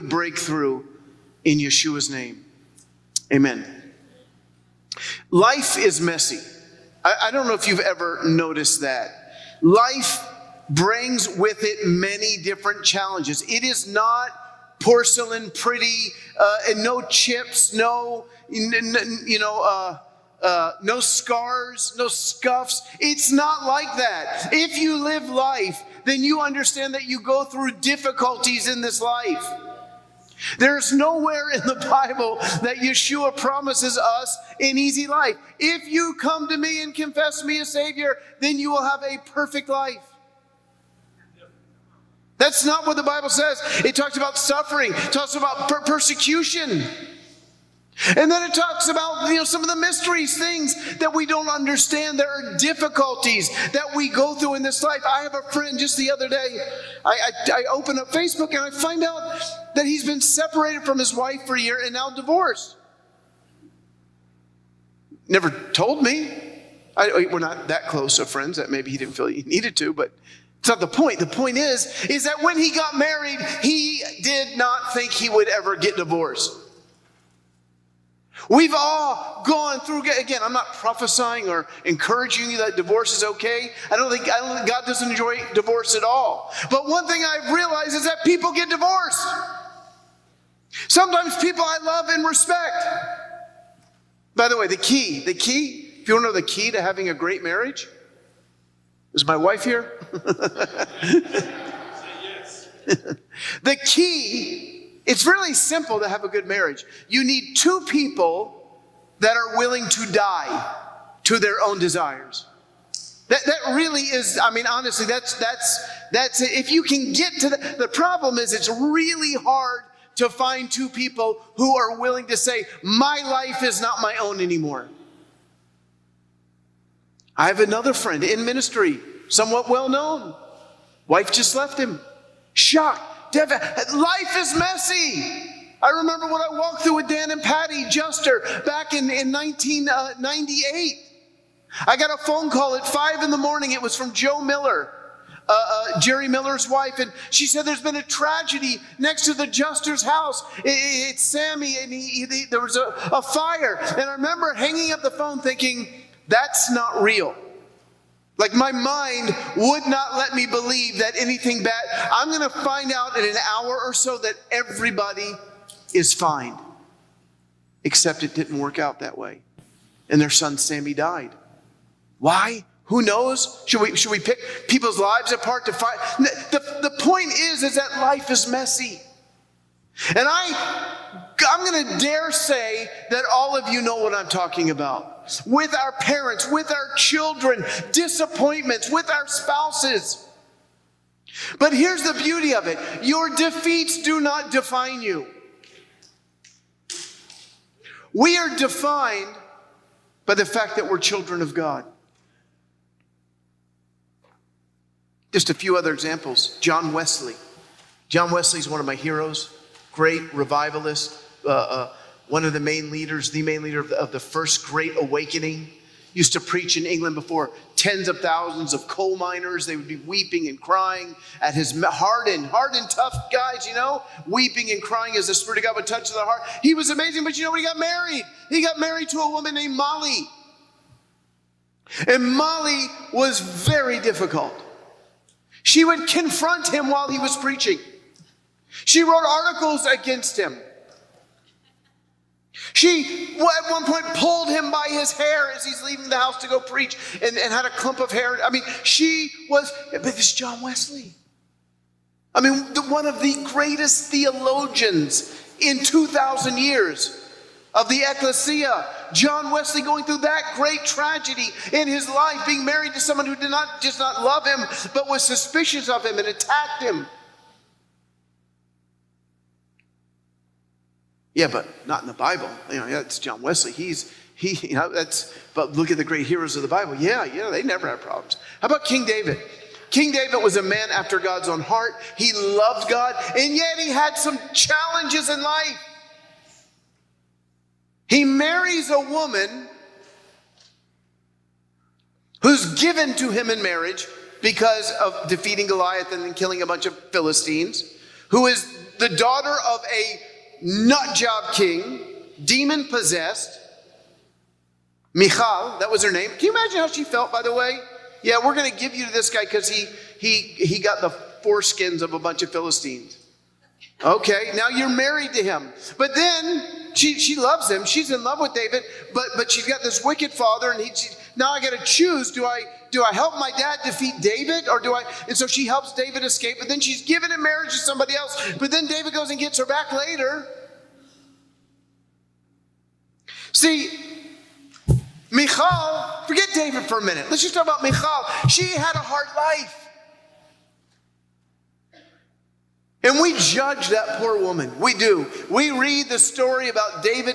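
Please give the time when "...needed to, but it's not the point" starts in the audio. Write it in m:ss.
1:09.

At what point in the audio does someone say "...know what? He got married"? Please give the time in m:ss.
3:47.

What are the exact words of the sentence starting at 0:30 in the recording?
There's nowhere in the Bible that Yeshua promises us an easy life.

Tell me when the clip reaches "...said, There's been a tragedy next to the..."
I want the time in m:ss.
2:27.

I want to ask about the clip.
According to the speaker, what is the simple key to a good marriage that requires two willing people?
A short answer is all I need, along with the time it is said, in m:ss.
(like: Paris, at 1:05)
die to their own desires, at 1:50.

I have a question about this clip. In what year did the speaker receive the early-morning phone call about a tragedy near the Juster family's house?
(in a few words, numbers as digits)
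1998.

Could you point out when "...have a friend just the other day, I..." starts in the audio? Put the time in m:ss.
0:55.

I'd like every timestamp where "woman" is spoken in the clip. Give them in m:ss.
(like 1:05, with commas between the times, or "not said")
3:49, 4:48, 5:44.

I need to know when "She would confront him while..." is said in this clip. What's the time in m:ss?
3:55.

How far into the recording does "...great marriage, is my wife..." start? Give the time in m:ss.
1:37.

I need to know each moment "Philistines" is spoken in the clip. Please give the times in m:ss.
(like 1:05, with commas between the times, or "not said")
4:57, 5:12.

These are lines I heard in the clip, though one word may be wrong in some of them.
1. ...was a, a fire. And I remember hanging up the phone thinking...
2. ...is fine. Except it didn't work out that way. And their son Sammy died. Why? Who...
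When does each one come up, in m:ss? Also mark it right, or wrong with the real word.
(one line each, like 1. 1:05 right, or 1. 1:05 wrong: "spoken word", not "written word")
1. 2:32 right
2. 2:45 right.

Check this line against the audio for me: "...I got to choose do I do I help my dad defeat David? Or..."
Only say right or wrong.
right.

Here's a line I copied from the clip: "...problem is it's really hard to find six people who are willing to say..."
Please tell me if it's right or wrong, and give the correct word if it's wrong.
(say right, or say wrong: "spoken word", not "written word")
wrong: "two", not "six".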